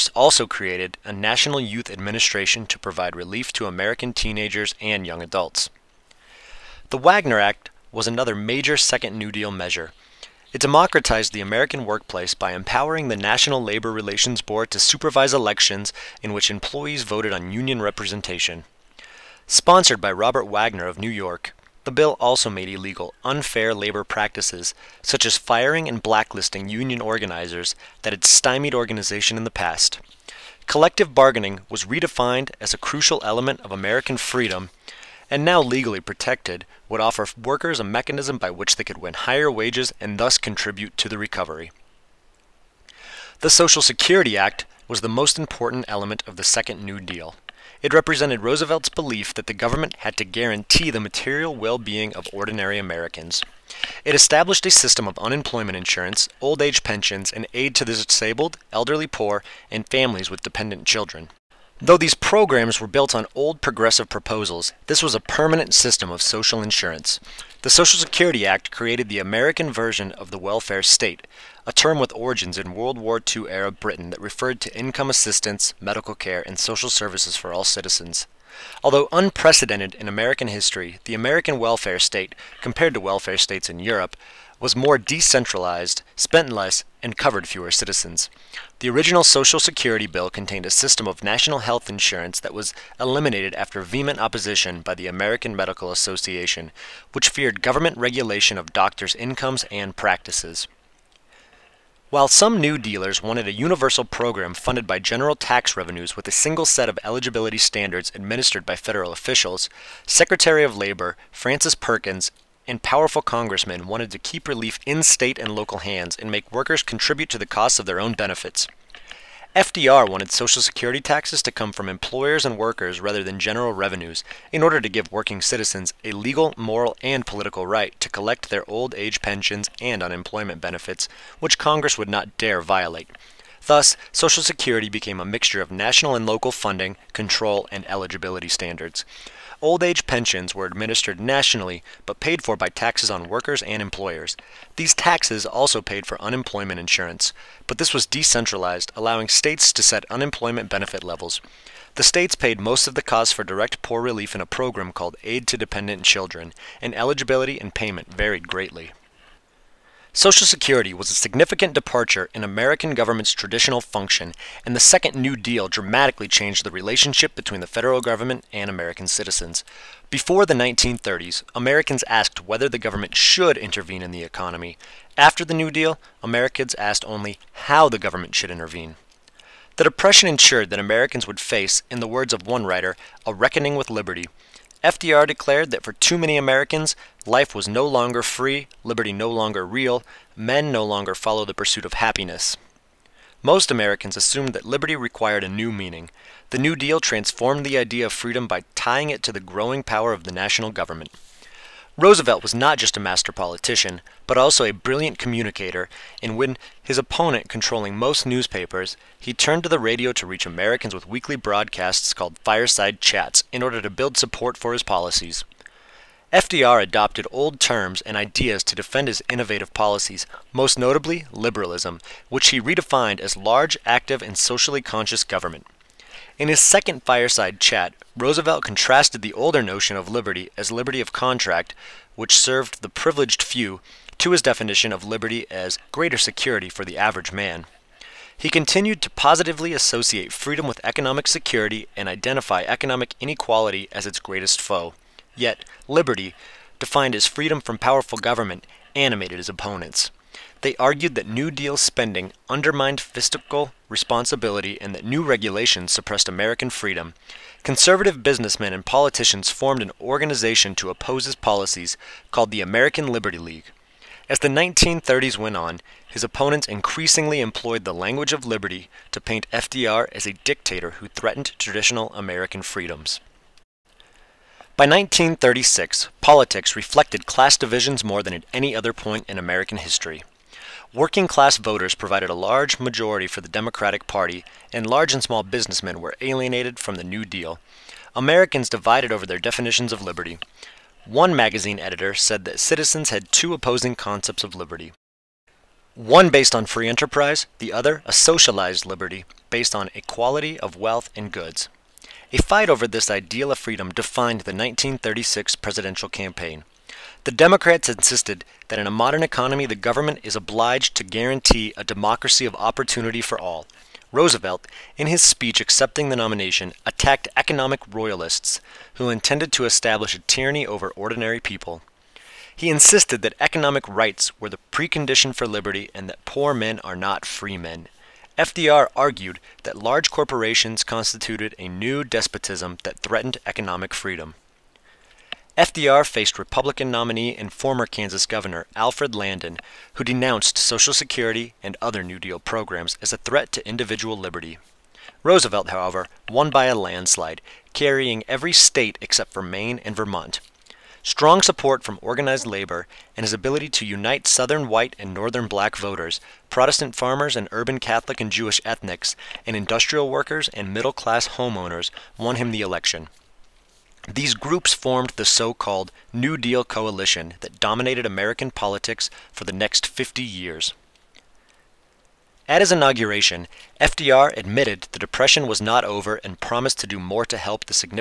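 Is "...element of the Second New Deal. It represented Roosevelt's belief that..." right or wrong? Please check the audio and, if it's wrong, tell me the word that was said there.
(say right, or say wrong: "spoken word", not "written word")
right.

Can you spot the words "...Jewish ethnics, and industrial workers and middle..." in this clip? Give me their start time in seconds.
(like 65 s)
358 s.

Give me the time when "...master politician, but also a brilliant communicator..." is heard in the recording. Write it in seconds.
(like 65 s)
202 s.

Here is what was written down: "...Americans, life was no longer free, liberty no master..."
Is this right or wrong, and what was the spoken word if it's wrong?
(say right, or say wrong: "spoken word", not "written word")
wrong: "longer", not "master".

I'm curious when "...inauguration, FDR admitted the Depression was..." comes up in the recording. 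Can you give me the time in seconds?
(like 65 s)
372 s.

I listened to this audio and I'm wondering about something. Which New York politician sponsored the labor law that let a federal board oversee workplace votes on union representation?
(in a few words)
Robert Wagner.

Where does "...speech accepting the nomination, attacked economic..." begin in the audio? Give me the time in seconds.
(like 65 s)
315 s.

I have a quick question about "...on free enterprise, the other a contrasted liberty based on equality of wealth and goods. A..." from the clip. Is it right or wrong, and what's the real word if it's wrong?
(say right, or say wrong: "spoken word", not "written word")
wrong: "socialized", not "contrasted".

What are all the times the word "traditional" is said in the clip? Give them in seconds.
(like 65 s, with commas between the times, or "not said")
163 s, 271 s.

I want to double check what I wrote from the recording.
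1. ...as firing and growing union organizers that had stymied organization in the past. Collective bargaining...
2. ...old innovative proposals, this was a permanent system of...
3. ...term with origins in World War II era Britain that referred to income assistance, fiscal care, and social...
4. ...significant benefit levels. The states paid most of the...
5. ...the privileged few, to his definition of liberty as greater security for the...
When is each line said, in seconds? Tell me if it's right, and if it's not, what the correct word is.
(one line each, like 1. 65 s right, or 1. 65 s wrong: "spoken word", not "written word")
1. 25 s wrong: "blacklisting", not "growing"
2. 63 s wrong: "progressive", not "innovative"
3. 71 s wrong: "medical", not "fiscal"
4. 150 s wrong: "unemployment", not "significant"
5. 232 s right.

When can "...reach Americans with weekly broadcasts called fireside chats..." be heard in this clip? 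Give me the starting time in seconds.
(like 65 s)
210 s.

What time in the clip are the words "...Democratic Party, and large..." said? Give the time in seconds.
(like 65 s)
283 s.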